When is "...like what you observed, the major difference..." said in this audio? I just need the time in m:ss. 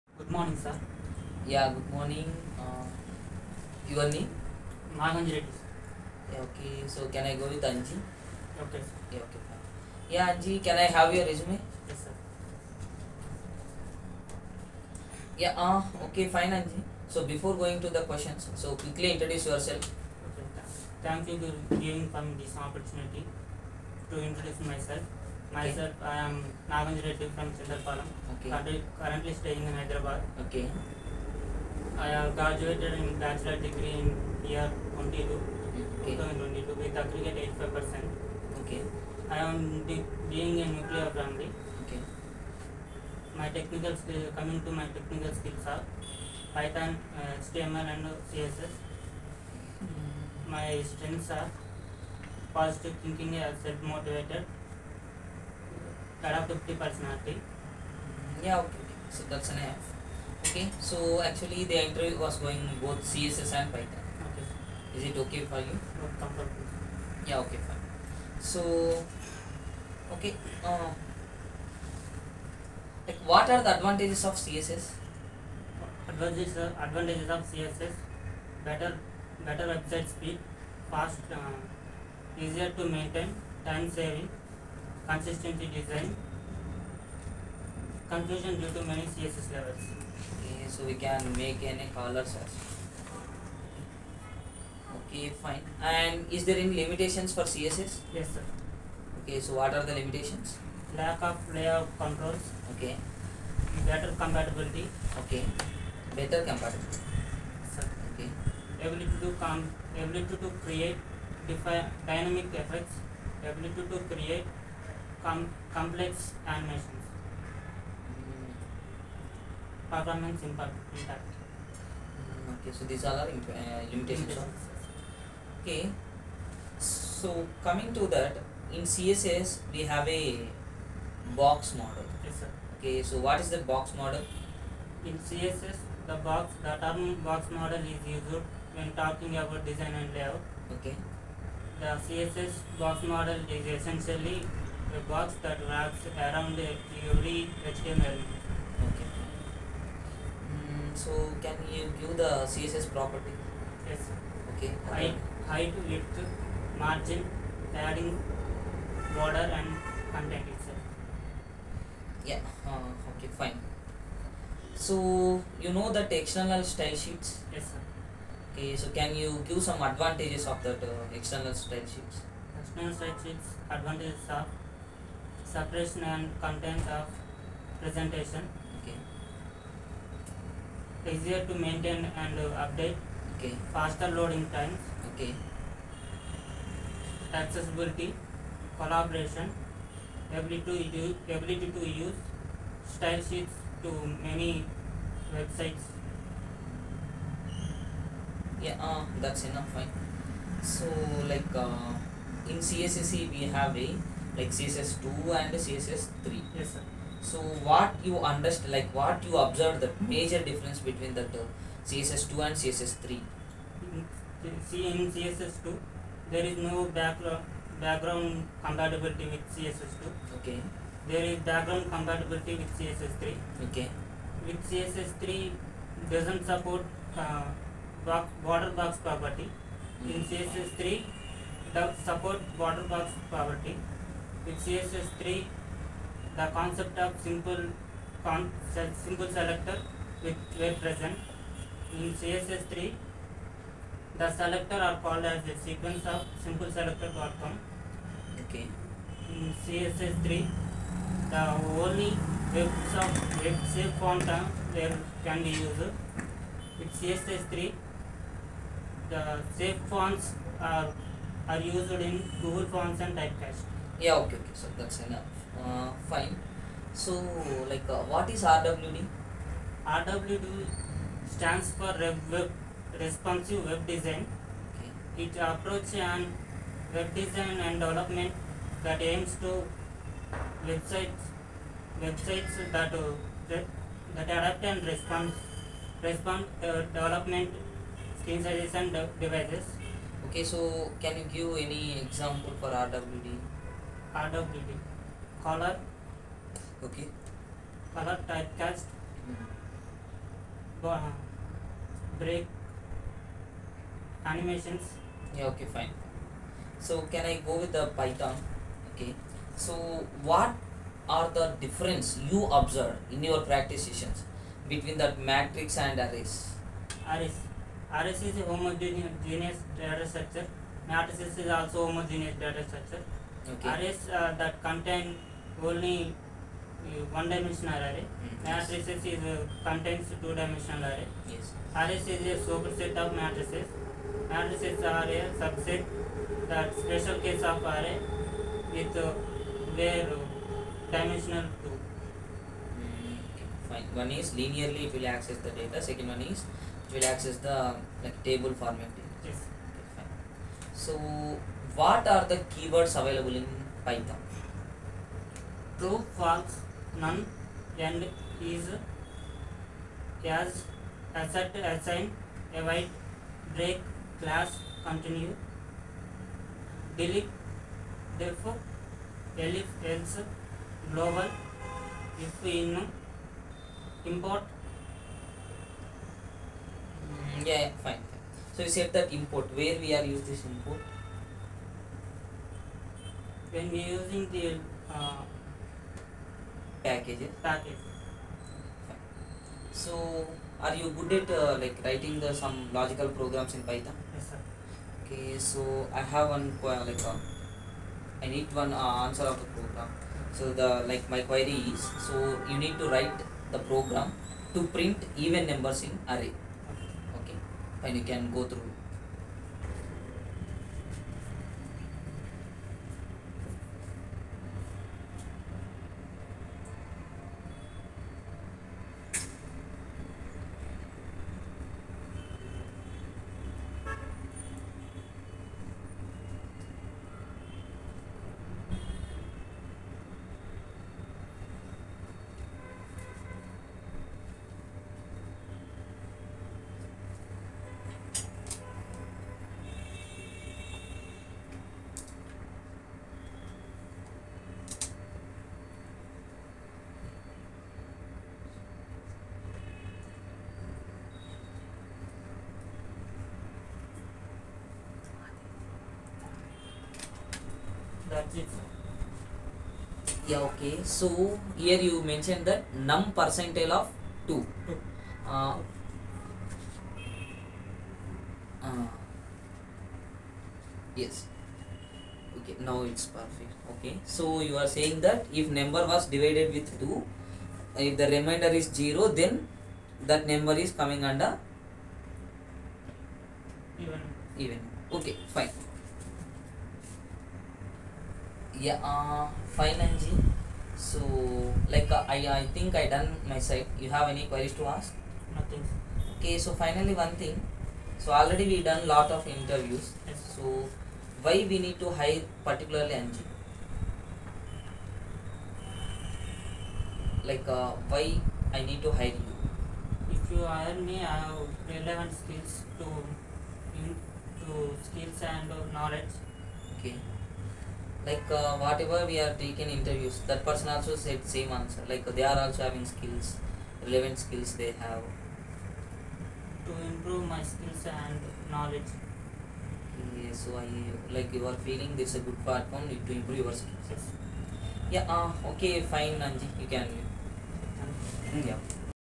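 3:28.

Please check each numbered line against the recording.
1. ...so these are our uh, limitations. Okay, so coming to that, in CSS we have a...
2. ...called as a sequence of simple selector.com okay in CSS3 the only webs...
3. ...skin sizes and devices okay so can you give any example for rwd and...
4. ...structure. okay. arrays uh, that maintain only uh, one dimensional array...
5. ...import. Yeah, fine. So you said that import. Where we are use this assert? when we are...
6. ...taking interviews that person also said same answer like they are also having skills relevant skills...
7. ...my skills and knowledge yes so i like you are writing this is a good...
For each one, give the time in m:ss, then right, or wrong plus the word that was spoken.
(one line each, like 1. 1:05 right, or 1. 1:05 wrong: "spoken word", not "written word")
1. 2:02 right
2. 4:05 right
3. 4:48 right
4. 5:22 wrong: "contain", not "maintain"
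5. 6:14 wrong: "import", not "assert"
6. 8:39 right
7. 8:47 wrong: "feeling", not "writing".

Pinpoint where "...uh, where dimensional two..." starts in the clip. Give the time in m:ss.
5:39.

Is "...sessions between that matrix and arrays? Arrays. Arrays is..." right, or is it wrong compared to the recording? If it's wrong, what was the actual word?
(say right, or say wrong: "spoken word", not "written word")
right.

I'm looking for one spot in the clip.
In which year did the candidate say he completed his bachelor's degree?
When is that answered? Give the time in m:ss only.
0:36.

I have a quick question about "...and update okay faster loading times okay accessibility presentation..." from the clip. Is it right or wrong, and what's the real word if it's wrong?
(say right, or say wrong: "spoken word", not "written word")
wrong: "collaboration", not "presentation".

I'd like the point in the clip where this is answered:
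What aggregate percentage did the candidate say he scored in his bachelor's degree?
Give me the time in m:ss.
0:37.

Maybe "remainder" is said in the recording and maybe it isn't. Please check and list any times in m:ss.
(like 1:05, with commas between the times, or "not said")
7:58.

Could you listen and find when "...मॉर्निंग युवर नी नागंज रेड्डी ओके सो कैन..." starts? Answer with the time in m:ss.
0:01.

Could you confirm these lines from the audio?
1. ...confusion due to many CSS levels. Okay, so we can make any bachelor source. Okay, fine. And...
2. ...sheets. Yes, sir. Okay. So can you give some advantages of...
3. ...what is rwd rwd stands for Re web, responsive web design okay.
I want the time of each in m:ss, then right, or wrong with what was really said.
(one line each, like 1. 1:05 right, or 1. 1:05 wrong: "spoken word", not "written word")
1. 1:28 wrong: "color", not "bachelor"
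2. 2:46 right
3. 4:28 right.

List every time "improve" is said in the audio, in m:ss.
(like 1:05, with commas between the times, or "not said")
8:46, 8:53.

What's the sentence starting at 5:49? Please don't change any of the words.
yes okay, fine so What are the keywords available in Python?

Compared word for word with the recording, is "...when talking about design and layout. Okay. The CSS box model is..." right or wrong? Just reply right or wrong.
right.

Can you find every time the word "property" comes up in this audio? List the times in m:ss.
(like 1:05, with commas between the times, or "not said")
2:32, 3:48, 3:53.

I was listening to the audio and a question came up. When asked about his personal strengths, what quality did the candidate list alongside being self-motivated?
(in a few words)
Positive thinking.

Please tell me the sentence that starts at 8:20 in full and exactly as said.
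so why we need to hire particularly Anji?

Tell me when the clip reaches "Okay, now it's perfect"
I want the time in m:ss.
7:52.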